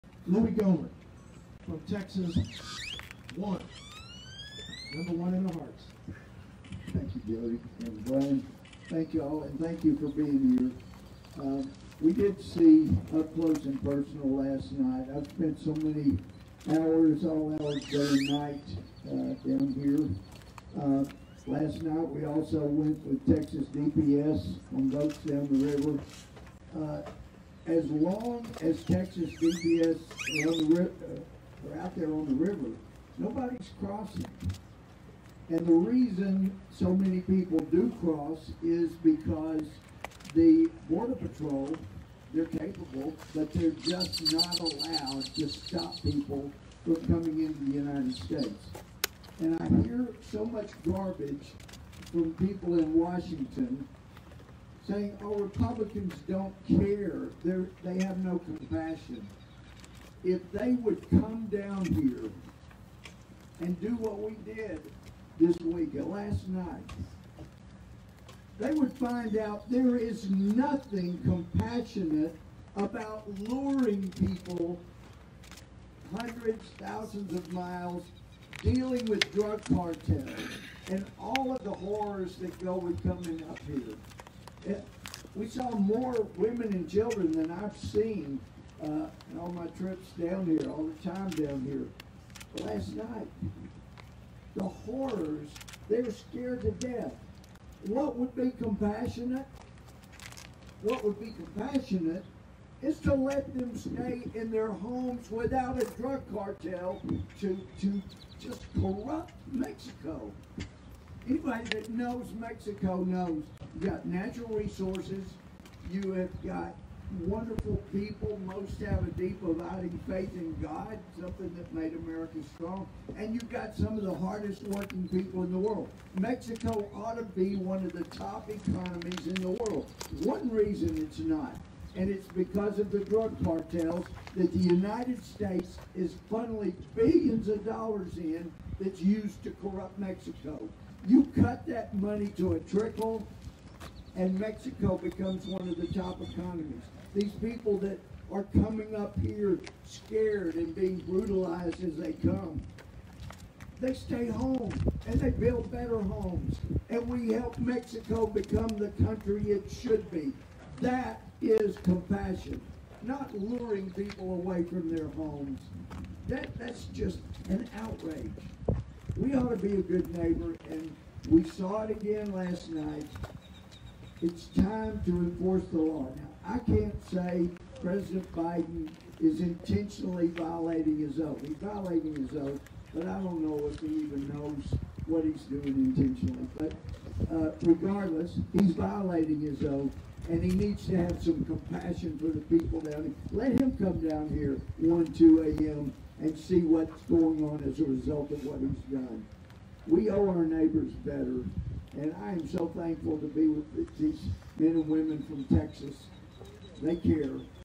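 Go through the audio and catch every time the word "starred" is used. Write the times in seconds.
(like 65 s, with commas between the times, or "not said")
not said.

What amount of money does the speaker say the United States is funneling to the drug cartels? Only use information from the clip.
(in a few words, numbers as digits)
billions of dollars.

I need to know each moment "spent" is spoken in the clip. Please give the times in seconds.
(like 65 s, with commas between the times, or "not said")
15 s.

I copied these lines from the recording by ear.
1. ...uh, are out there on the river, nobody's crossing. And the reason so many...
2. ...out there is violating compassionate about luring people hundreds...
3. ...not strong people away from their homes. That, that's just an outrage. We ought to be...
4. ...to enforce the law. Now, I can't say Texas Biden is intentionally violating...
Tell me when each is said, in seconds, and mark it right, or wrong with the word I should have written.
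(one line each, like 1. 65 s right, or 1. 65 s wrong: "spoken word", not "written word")
1. 30 s right
2. 69 s wrong: "nothing", not "violating"
3. 163 s wrong: "luring", not "strong"
4. 175 s wrong: "President", not "Texas".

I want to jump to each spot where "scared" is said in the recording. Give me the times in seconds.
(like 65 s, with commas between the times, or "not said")
96 s, 149 s.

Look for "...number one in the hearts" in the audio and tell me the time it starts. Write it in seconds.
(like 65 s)
4 s.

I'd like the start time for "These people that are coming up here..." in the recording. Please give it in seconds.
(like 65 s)
147 s.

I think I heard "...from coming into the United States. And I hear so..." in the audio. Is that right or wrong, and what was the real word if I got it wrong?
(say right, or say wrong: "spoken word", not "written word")
right.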